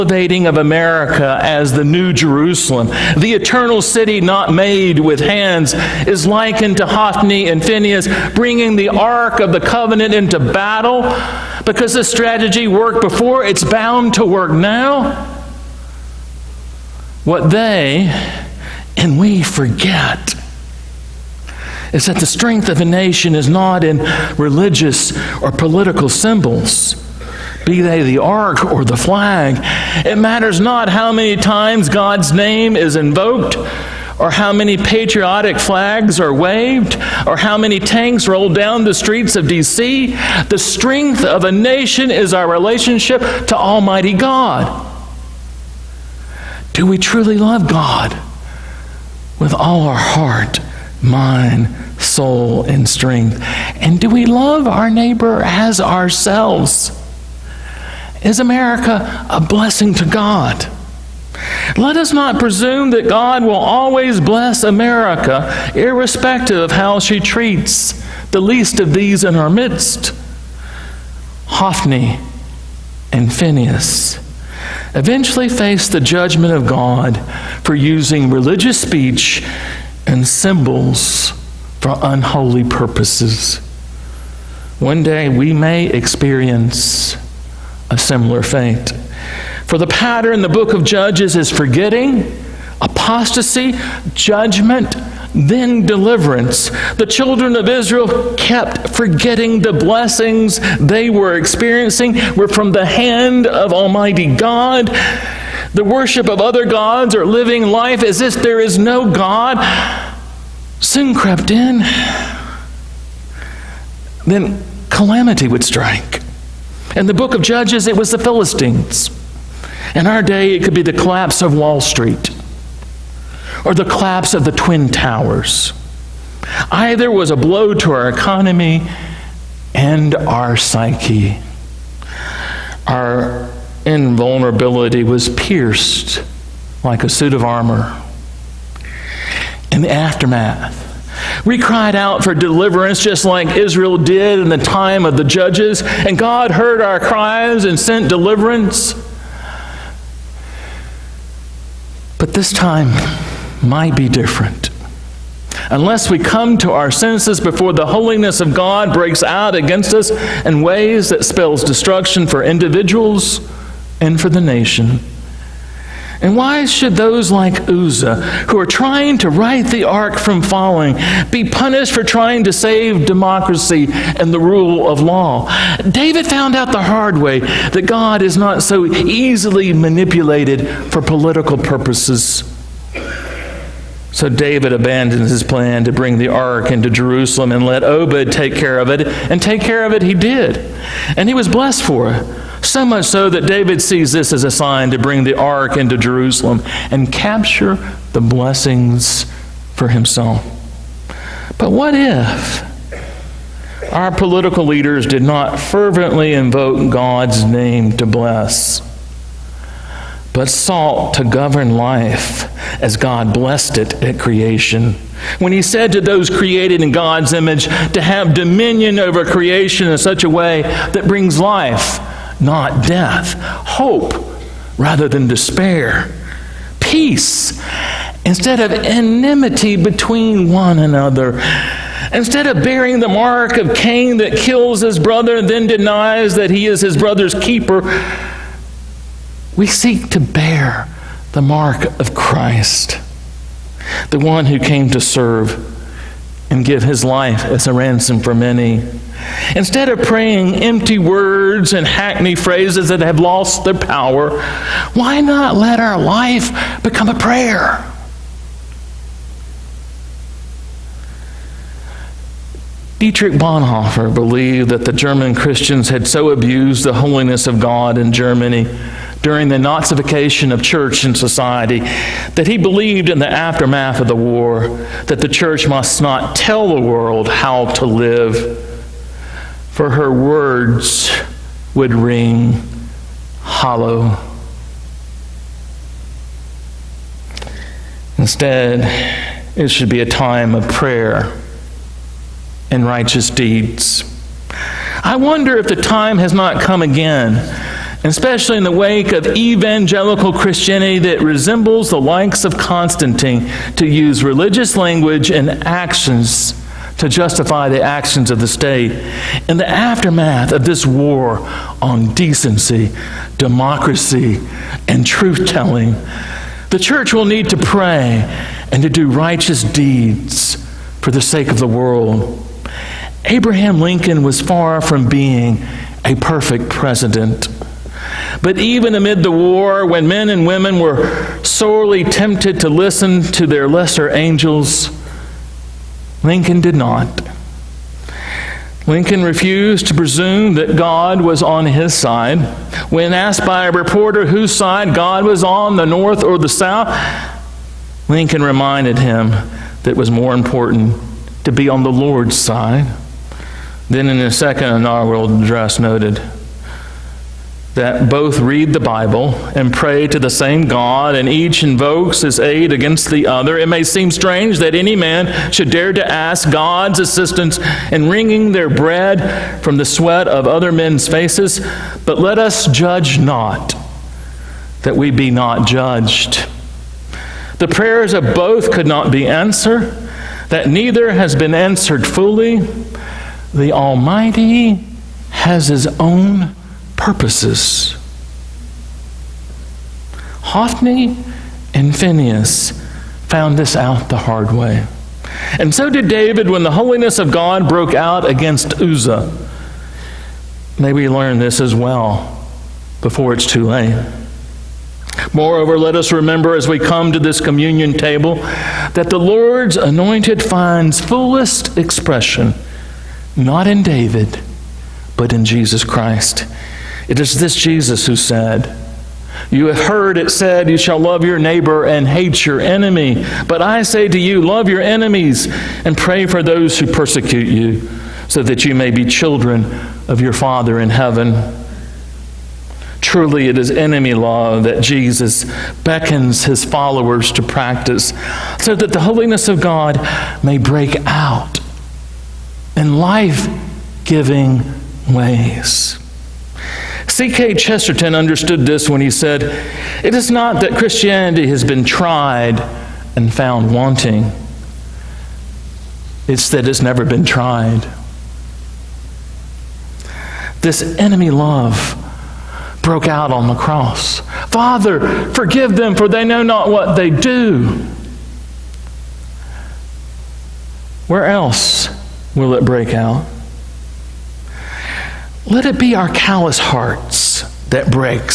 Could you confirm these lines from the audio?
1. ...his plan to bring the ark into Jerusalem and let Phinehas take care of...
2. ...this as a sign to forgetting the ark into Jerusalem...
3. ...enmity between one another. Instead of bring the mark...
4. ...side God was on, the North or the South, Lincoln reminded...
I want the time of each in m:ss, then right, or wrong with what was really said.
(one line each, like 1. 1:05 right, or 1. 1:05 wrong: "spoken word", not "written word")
1. 3:05 wrong: "Obed", not "Phinehas"
2. 3:14 wrong: "bring", not "forgetting"
3. 3:48 wrong: "bearing", not "bring"
4. 5:44 right.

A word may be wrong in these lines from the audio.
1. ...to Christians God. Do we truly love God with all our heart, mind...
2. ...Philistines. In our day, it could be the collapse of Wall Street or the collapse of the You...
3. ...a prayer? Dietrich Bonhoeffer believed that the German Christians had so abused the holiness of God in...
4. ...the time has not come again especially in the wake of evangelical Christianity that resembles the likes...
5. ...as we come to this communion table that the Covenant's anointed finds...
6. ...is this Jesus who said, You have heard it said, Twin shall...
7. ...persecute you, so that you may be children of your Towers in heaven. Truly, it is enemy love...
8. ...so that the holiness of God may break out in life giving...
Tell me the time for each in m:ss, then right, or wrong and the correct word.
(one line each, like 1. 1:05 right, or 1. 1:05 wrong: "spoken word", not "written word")
1. 0:43 wrong: "Almighty", not "Christians"
2. 1:58 wrong: "Twin", not "You"
3. 4:17 right
4. 4:55 right
5. 6:46 wrong: "Lord", not "Covenant"
6. 6:57 wrong: "You", not "Twin"
7. 7:06 wrong: "Father", not "Towers"
8. 7:18 right.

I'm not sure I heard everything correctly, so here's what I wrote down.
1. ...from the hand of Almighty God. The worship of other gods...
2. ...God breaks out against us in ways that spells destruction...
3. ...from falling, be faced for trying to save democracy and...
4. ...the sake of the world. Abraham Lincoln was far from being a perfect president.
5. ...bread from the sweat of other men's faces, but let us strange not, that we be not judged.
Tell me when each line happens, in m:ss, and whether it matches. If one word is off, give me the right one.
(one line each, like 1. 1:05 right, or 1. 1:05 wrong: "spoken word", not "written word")
1. 1:42 right
2. 2:38 right
3. 2:50 wrong: "punished", not "faced"
4. 5:21 right
5. 6:08 wrong: "judge", not "strange".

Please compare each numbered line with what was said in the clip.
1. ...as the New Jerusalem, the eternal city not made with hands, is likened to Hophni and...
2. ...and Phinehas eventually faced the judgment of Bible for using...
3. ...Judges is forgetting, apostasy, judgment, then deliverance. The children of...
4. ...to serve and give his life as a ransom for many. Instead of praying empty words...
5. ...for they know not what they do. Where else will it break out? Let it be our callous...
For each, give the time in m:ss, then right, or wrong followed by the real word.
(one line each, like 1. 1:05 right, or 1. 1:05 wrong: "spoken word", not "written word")
1. 0:01 right
2. 1:13 wrong: "God", not "Bible"
3. 1:30 right
4. 4:04 right
5. 7:45 right.